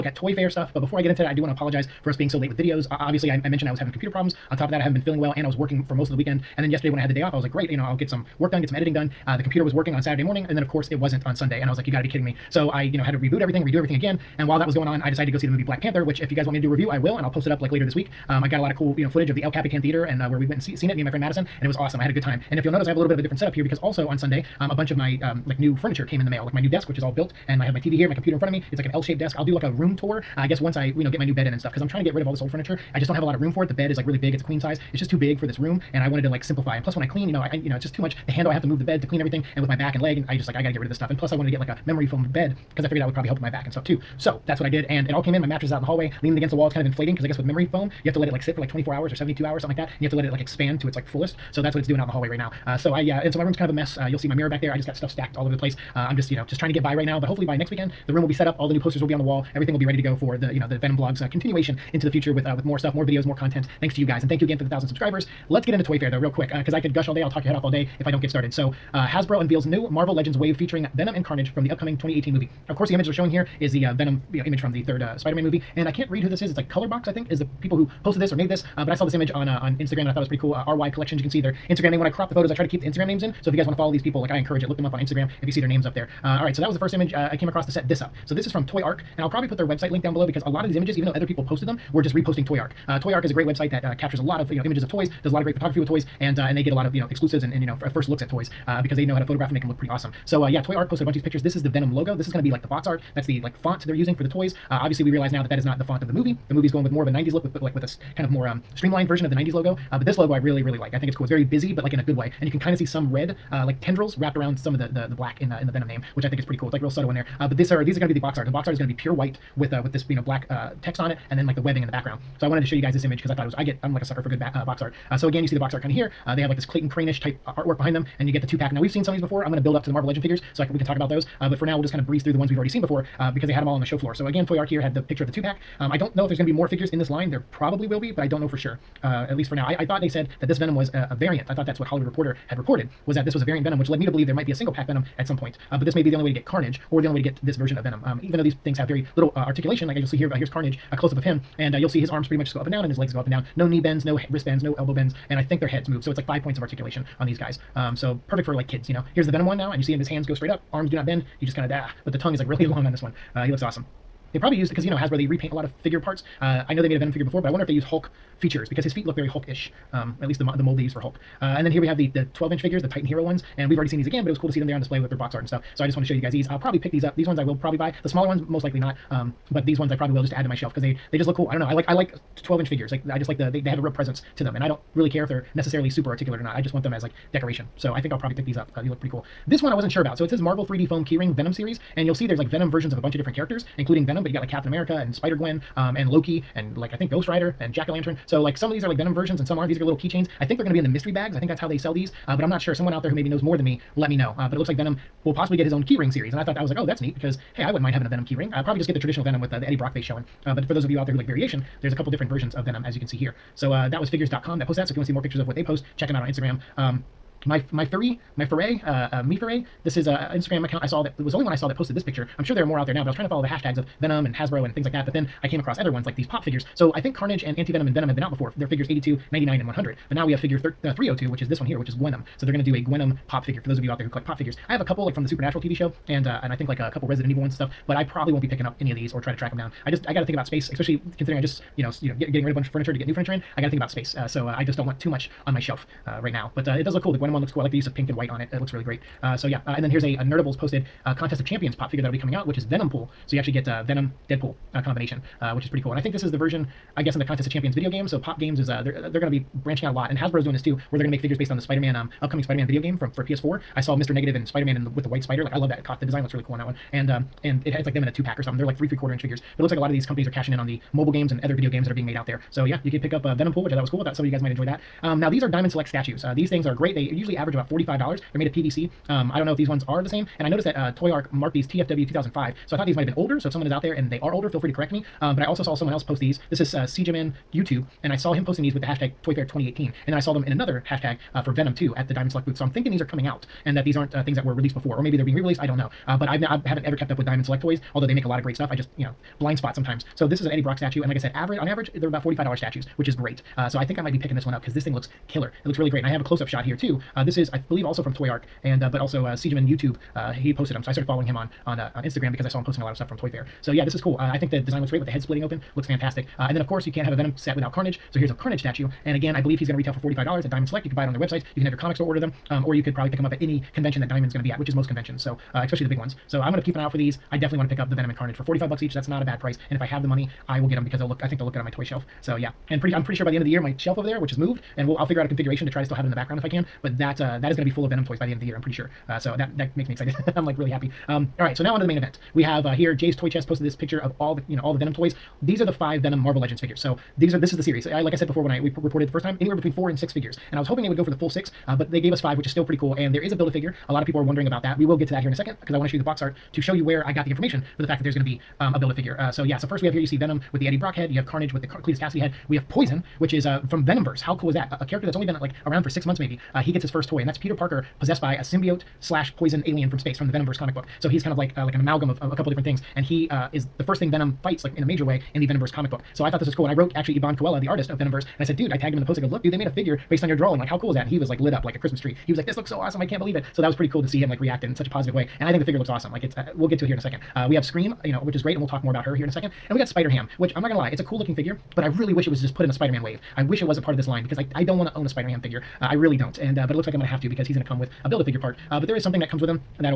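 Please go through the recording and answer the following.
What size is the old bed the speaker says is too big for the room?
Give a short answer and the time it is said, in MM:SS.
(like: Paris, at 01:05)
queen size, at 00:34.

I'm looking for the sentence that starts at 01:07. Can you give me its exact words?
I'll talk your head off all day if I don't get started.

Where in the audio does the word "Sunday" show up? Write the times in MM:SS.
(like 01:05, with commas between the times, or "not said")
00:11, 00:24.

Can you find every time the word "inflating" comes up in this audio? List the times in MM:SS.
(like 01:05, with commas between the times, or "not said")
00:46.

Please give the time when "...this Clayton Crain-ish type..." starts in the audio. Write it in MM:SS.
02:06.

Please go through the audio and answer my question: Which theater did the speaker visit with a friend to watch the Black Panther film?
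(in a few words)
El Capitan Theater.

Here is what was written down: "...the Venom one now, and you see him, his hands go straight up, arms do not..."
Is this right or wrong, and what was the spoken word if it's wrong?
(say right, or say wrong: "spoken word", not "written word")
right.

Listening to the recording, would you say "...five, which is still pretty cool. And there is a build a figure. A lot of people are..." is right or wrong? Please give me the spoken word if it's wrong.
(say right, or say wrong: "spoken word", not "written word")
right.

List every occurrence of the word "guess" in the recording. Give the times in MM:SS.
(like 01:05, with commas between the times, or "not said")
00:30, 00:47, 04:17.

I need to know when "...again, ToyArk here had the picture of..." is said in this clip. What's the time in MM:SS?
02:14.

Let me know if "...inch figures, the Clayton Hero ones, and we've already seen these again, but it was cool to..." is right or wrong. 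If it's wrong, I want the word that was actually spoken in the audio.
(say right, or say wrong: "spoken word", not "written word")
wrong: "Titan", not "Clayton".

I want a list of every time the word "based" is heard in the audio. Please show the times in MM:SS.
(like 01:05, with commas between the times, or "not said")
04:21, 06:20.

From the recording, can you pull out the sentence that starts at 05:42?
We have uh, here Jay's Toy Chest posted this picture of all the you know all the Venom toys.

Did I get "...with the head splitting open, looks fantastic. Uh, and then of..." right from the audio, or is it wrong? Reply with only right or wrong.
right.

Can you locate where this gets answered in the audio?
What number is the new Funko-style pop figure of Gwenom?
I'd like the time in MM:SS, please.
03:50.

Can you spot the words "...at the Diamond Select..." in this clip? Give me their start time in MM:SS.
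04:51.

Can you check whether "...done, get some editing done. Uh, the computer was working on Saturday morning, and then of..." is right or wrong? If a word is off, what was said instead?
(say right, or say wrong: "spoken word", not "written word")
right.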